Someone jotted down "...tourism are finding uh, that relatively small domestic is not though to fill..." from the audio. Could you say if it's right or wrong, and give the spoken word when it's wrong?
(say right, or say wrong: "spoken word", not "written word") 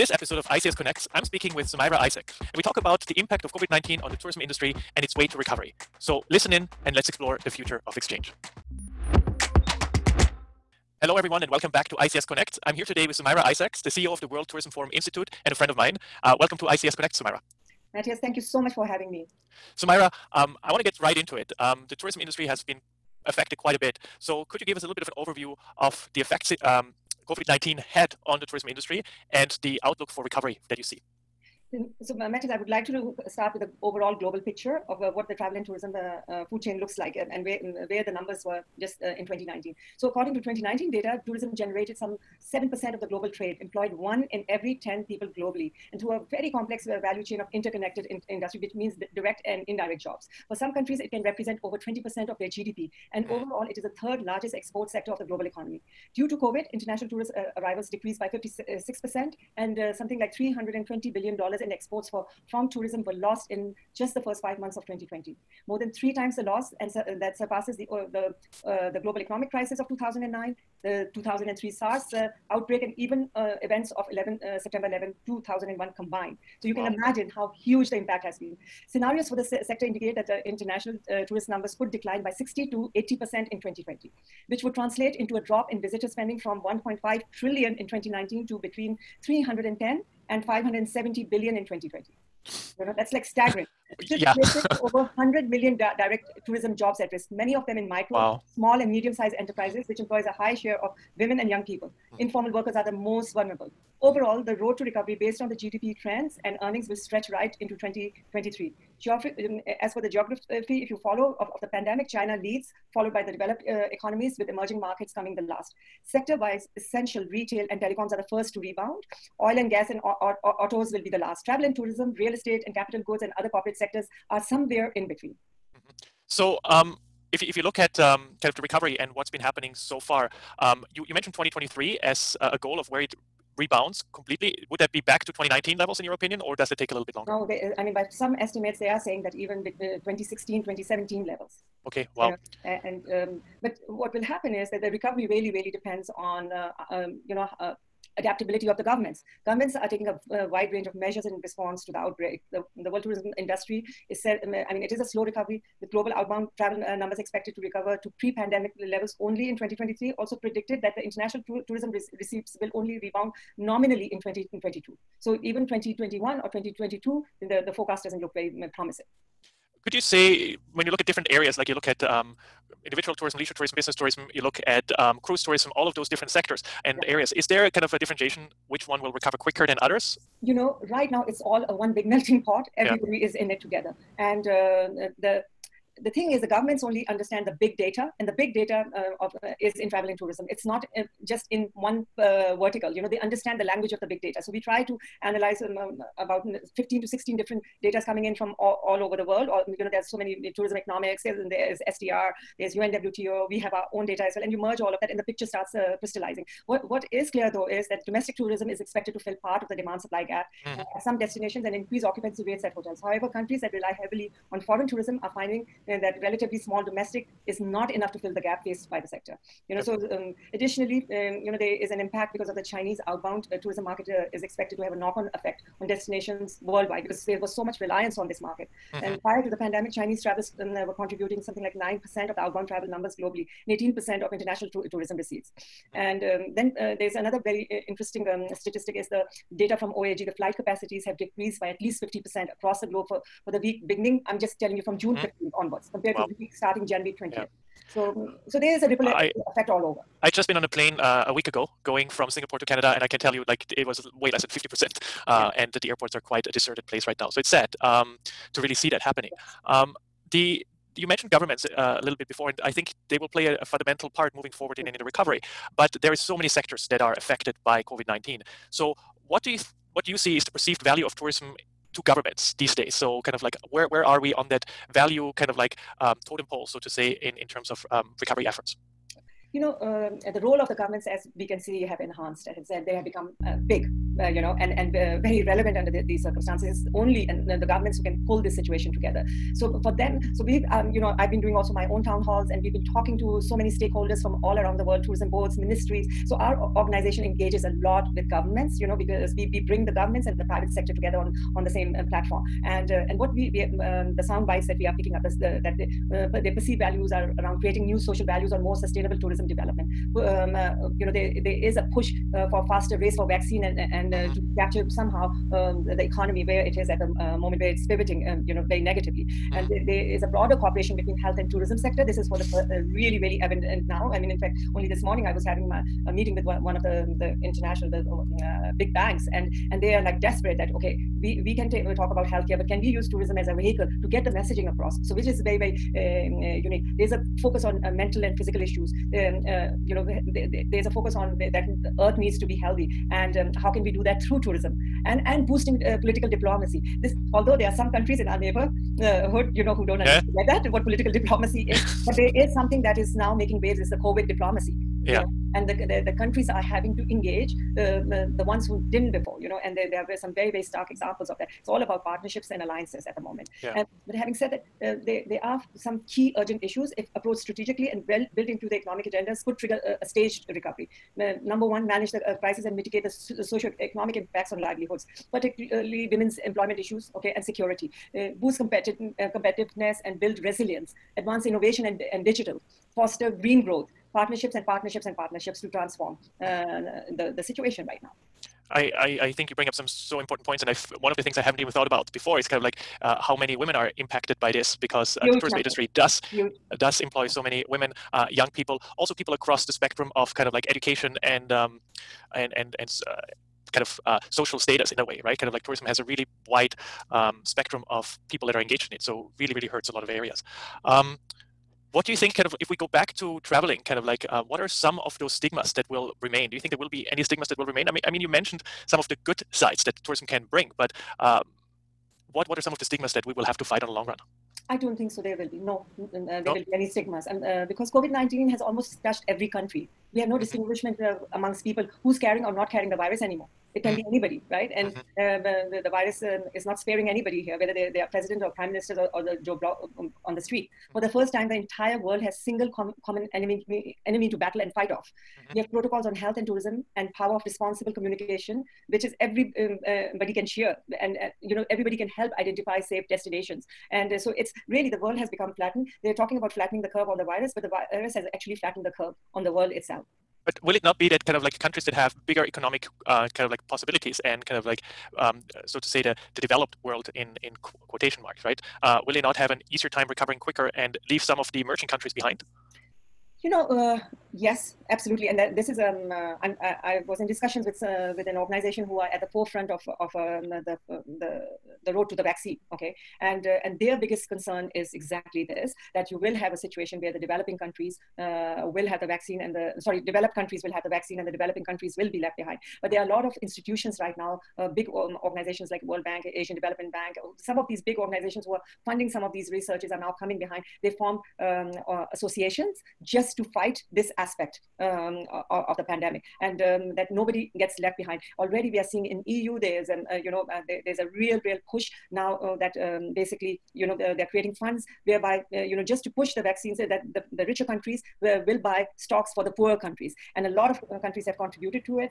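wrong: "enough", not "though".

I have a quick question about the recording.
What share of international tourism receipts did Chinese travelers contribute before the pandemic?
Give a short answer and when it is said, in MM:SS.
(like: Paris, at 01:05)
18%, at 03:53.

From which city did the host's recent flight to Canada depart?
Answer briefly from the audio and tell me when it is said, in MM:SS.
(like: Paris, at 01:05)
Singapore, at 04:12.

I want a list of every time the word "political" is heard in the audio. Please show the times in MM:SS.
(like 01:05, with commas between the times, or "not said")
05:46, 05:50.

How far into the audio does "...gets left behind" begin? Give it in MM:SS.
08:27.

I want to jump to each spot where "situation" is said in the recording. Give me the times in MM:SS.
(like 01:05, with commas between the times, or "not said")
04:48, 06:27, 08:06.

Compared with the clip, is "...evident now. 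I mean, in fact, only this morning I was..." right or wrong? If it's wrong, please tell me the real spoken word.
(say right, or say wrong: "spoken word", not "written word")
right.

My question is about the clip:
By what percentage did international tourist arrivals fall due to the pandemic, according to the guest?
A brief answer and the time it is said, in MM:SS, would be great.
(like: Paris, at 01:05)
56%, at 00:58.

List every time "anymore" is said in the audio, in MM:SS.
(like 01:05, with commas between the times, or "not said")
07:13.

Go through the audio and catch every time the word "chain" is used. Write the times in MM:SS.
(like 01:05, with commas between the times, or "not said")
00:36, 00:47.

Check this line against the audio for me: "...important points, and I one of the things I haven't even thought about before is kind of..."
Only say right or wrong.
right.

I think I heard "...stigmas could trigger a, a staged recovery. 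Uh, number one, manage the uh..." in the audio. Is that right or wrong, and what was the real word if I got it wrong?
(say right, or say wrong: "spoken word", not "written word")
wrong: "agendas", not "stigmas".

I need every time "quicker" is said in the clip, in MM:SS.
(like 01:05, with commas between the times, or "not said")
02:59, 07:50.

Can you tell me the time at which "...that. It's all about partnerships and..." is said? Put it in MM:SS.
06:01.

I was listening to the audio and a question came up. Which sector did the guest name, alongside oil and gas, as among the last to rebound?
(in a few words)
autos.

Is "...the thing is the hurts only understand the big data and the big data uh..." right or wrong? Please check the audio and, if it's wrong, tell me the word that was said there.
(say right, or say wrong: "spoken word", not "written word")
wrong: "governments", not "hurts".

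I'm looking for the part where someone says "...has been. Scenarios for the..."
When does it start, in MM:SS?
01:18.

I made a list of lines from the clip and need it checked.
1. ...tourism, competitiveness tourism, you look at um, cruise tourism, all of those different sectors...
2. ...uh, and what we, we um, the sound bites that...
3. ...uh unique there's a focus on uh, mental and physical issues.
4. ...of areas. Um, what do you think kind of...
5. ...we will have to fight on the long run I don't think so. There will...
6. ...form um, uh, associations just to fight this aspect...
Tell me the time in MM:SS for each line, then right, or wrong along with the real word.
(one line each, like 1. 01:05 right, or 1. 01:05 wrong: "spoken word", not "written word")
1. 02:53 wrong: "business", not "competitiveness"
2. 05:02 right
3. 05:36 right
4. 06:50 right
5. 07:03 right
6. 08:20 right.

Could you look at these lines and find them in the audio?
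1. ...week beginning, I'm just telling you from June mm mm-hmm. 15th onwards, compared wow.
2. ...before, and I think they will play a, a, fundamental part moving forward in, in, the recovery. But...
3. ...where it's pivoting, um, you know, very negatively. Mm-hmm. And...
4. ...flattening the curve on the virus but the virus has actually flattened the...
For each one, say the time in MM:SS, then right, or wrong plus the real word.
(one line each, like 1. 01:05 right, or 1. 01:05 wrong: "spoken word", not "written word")
1. 04:03 right
2. 04:22 right
3. 05:17 right
4. 07:36 right.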